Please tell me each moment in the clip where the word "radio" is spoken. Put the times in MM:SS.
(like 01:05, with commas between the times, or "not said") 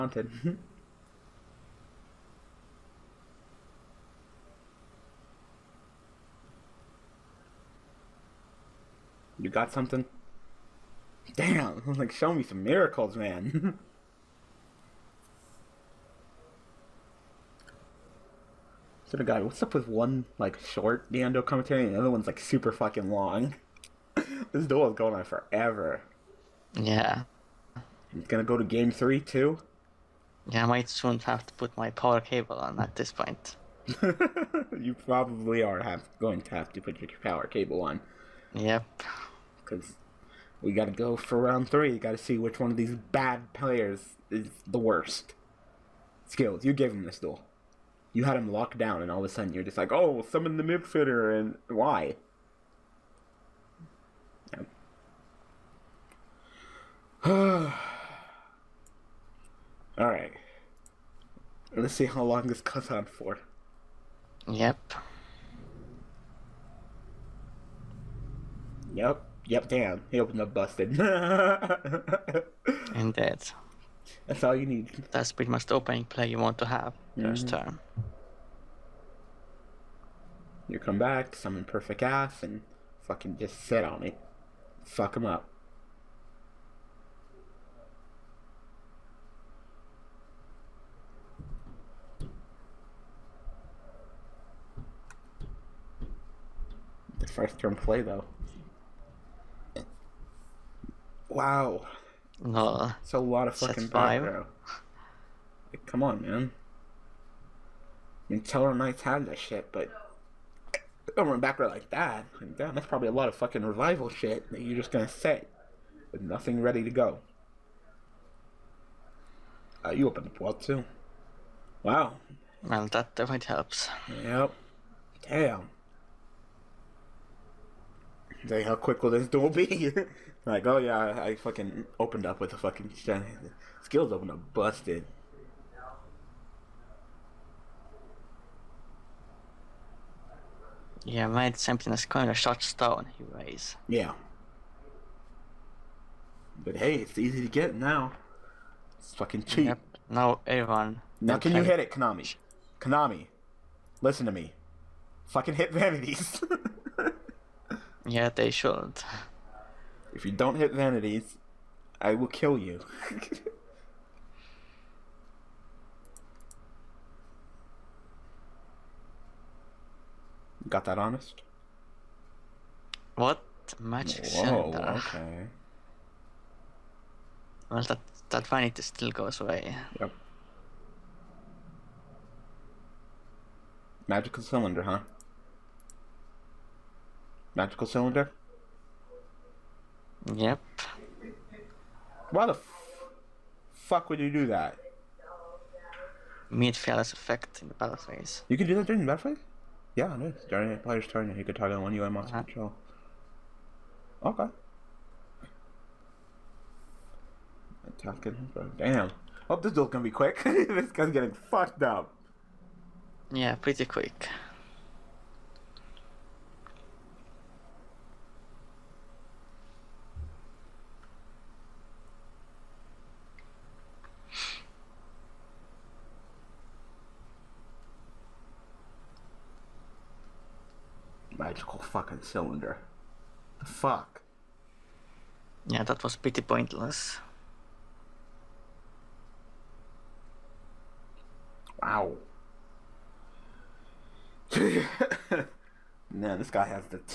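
not said.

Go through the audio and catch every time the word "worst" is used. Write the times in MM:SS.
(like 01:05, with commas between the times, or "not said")
00:44.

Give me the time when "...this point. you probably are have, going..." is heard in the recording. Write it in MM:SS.
00:32.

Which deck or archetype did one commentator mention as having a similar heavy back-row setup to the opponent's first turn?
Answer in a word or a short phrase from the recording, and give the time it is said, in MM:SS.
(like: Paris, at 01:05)
Tellarknights, at 01:48.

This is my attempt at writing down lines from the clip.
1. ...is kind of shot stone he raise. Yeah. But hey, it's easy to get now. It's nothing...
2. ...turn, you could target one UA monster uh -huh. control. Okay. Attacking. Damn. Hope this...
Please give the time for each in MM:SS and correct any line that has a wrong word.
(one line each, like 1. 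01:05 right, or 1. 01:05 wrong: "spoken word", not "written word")
1. 02:21 wrong: "fucking", not "nothing"
2. 03:21 right.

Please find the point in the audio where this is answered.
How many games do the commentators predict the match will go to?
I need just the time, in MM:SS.
00:28.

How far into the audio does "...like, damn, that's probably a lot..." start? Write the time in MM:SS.
01:52.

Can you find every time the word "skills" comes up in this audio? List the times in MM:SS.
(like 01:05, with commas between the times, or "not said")
00:46, 02:13.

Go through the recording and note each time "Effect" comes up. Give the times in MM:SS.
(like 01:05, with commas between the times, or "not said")
03:17.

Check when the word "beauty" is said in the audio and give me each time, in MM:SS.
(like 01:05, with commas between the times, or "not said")
not said.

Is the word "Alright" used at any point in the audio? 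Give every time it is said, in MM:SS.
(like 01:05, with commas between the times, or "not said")
00:57.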